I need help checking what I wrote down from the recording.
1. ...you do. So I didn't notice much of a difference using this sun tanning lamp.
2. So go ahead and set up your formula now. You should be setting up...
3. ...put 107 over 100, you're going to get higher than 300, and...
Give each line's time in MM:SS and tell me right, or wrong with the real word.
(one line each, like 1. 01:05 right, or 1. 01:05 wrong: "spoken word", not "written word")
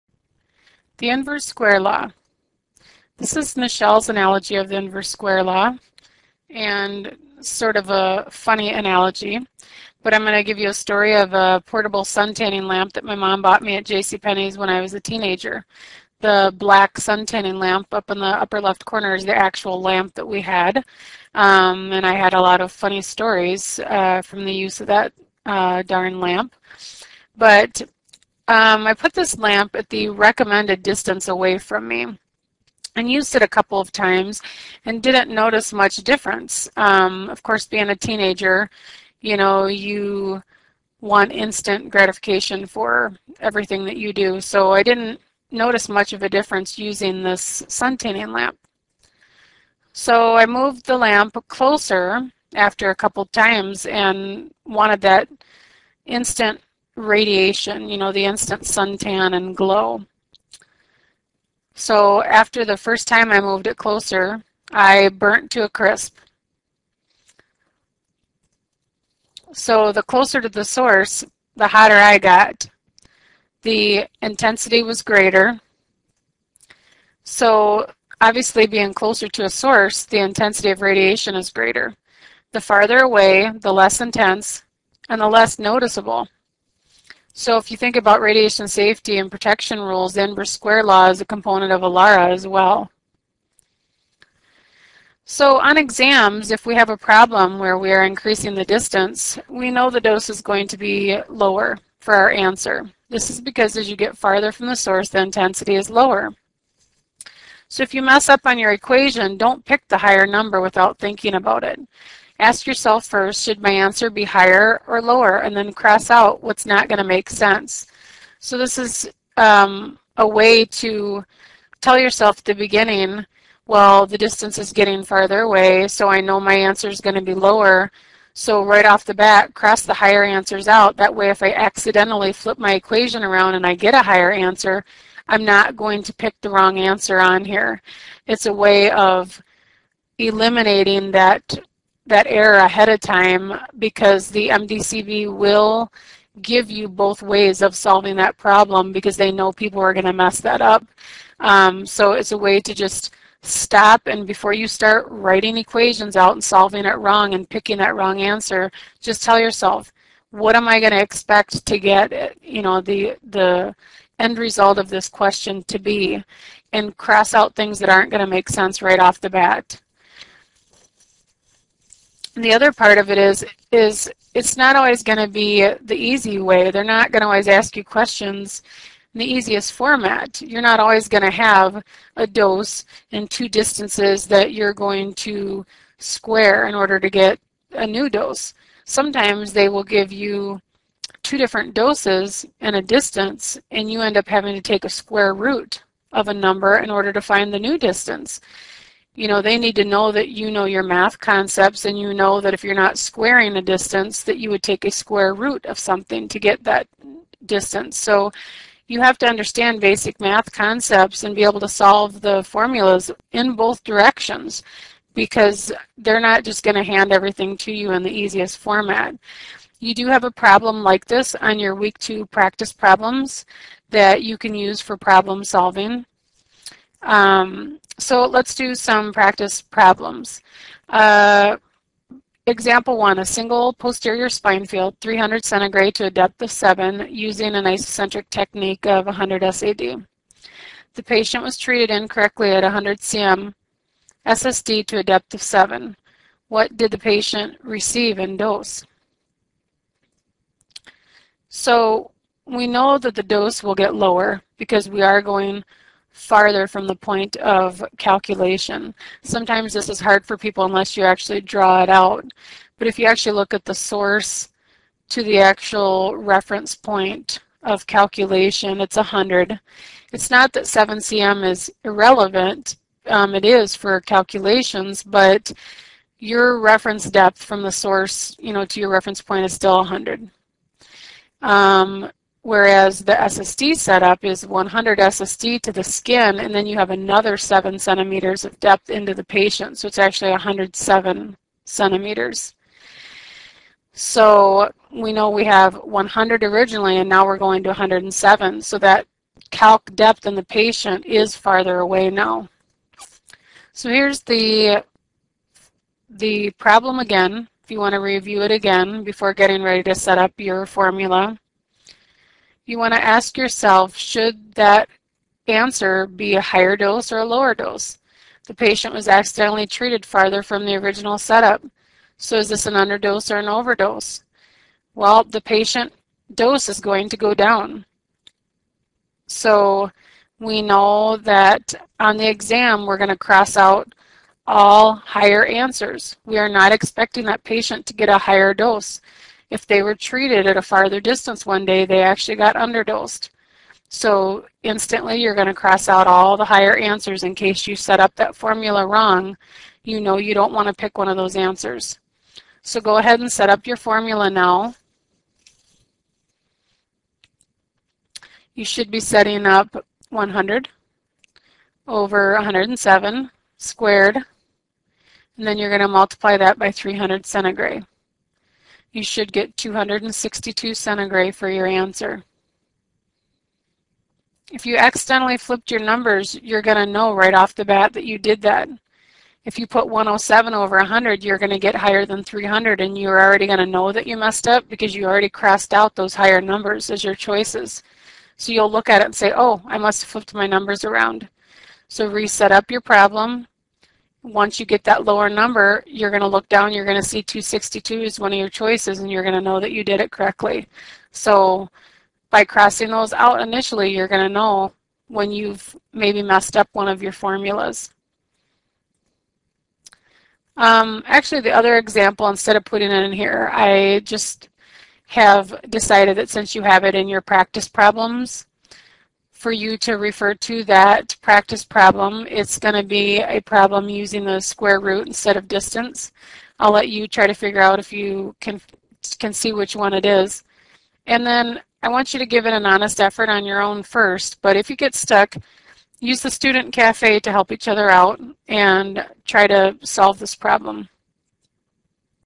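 1. 00:43 right
2. 05:52 right
3. 06:19 right.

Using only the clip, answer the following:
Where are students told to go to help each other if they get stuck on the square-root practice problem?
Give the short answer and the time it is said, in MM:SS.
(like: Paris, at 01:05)
the student cafe, at 07:16.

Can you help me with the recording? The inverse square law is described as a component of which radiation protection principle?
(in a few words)
ALARA.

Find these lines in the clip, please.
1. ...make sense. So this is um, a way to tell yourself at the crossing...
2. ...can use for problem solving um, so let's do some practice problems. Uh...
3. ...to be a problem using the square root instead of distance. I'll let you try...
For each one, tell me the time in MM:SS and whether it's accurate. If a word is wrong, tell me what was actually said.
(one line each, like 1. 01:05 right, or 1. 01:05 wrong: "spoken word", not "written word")
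1. 01:57 wrong: "beginning", not "crossing"
2. 03:44 right
3. 07:02 right.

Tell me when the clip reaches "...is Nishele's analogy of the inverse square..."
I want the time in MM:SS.
00:03.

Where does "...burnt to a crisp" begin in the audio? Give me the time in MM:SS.
01:05.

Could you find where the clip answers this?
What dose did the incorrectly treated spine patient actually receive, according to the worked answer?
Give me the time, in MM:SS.
06:09.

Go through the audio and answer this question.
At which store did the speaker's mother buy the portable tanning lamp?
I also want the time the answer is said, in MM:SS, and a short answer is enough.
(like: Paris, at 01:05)
JCPenney's, at 00:13.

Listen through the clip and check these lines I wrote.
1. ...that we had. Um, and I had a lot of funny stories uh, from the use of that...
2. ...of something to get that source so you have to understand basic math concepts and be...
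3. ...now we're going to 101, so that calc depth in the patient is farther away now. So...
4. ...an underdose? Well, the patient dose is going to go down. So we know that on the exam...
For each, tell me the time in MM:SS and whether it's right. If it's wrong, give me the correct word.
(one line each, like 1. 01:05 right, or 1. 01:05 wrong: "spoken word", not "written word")
1. 00:20 right
2. 03:25 wrong: "distance", not "source"
3. 04:57 wrong: "107", not "101"
4. 05:23 wrong: "overdose", not "underdose".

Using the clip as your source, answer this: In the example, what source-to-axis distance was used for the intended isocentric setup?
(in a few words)
100 SAD.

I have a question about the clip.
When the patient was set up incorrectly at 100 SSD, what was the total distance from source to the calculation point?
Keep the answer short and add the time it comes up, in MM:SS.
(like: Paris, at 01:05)
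107 centimeters, at 04:50.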